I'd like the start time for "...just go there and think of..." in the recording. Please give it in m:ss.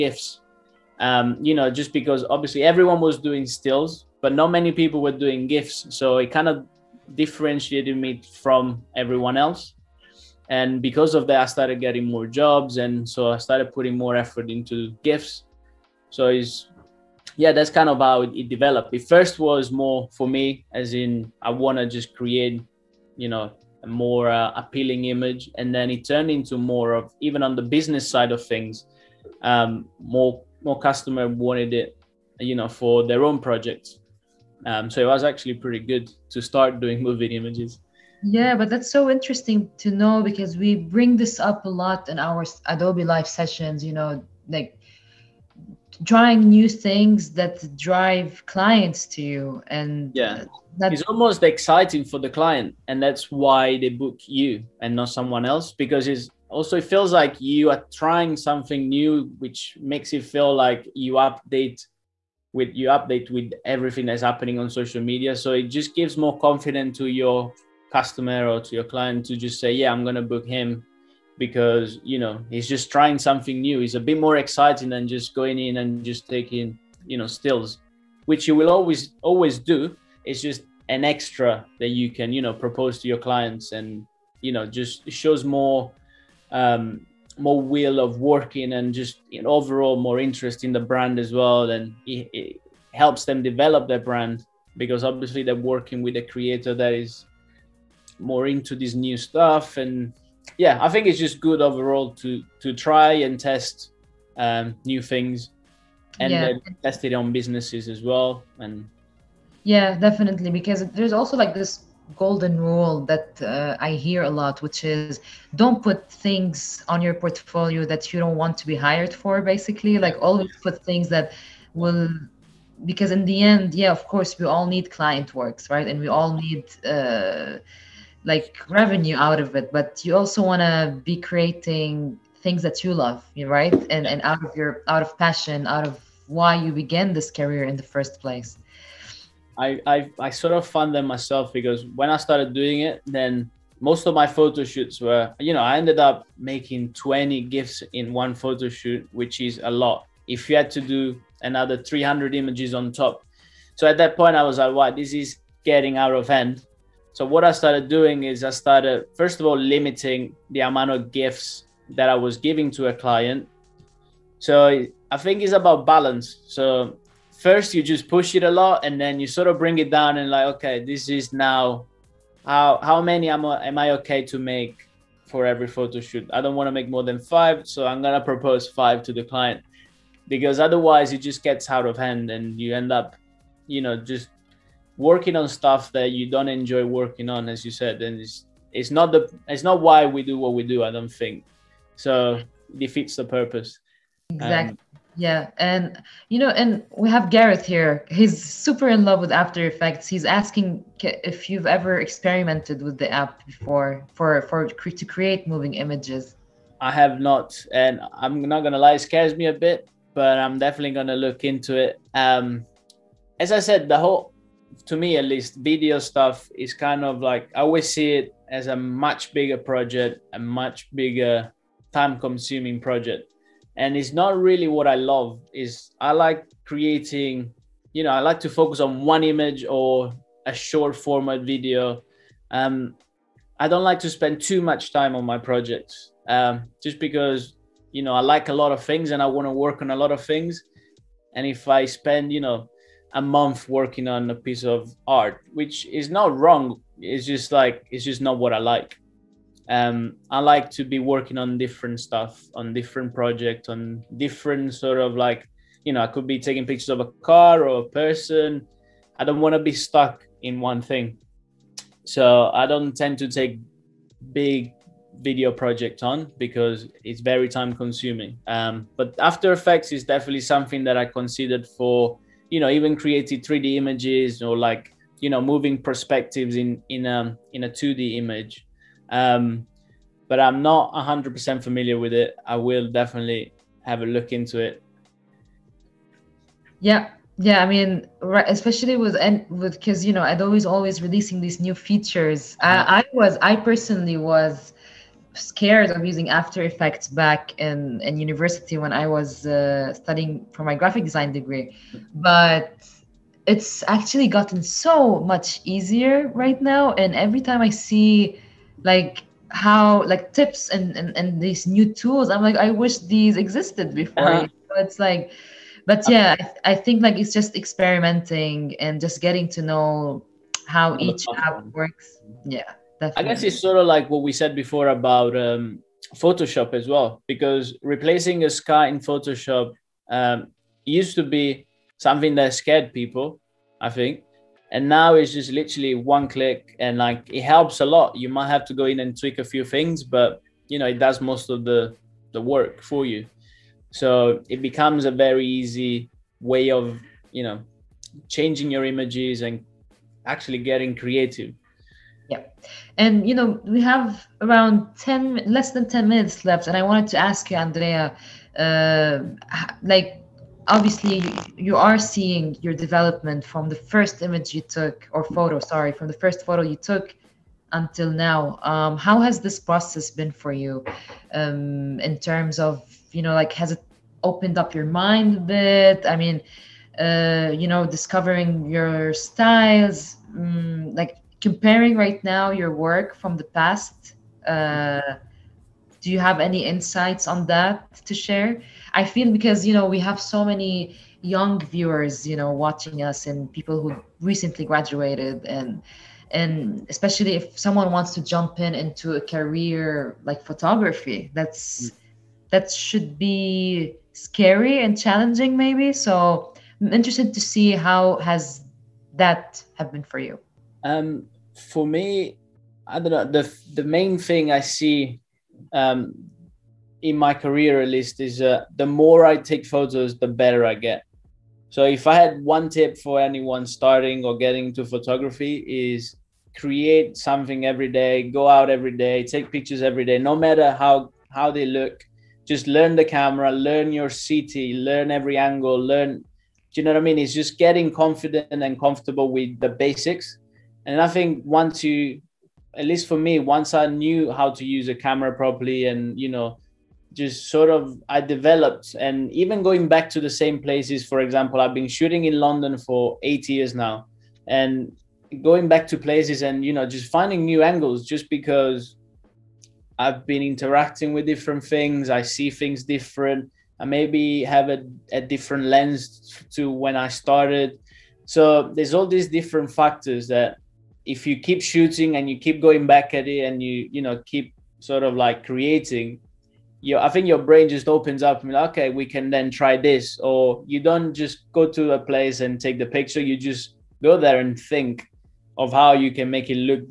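8:03.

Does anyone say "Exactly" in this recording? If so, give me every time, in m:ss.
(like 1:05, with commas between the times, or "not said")
3:14.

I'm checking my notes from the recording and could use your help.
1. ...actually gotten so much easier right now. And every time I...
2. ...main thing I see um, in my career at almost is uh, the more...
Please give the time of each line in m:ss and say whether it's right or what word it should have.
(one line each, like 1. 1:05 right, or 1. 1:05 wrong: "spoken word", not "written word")
1. 5:03 right
2. 6:53 wrong: "least", not "almost".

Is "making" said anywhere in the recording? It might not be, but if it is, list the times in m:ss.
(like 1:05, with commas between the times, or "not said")
2:26.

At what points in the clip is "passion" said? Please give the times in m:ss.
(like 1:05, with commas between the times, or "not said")
2:15.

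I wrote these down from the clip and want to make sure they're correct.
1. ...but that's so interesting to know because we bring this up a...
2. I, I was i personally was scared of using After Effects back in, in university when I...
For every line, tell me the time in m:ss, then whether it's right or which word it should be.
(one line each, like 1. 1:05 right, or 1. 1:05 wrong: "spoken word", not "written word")
1. 0:38 right
2. 4:52 right.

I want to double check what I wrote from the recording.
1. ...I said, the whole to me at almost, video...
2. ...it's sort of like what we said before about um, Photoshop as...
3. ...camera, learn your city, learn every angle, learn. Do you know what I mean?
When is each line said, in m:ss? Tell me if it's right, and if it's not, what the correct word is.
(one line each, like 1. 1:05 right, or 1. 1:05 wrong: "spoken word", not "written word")
1. 3:33 wrong: "least", not "almost"
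2. 5:23 right
3. 7:13 right.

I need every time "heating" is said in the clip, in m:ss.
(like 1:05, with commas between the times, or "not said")
not said.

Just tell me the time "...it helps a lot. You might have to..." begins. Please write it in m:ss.
5:37.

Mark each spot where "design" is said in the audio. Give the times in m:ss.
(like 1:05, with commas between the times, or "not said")
5:01.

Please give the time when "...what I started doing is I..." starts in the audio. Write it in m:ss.
2:37.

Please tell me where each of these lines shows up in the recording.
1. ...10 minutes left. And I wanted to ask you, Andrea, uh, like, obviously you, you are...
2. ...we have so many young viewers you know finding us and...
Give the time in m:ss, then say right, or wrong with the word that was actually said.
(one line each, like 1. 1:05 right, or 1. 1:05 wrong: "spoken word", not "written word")
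1. 5:55 right
2. 6:29 wrong: "watching", not "finding".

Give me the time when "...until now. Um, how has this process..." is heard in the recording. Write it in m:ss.
6:07.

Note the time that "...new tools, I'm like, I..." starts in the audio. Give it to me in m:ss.
5:11.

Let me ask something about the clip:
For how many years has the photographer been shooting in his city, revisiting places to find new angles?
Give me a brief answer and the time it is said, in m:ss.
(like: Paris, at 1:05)
8, at 7:33.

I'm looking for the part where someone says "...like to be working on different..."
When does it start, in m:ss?
4:10.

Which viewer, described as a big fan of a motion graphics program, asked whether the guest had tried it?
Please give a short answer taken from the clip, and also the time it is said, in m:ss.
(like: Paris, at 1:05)
Gareth, at 3:17.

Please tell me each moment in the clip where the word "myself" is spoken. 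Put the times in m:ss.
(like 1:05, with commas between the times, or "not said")
2:21.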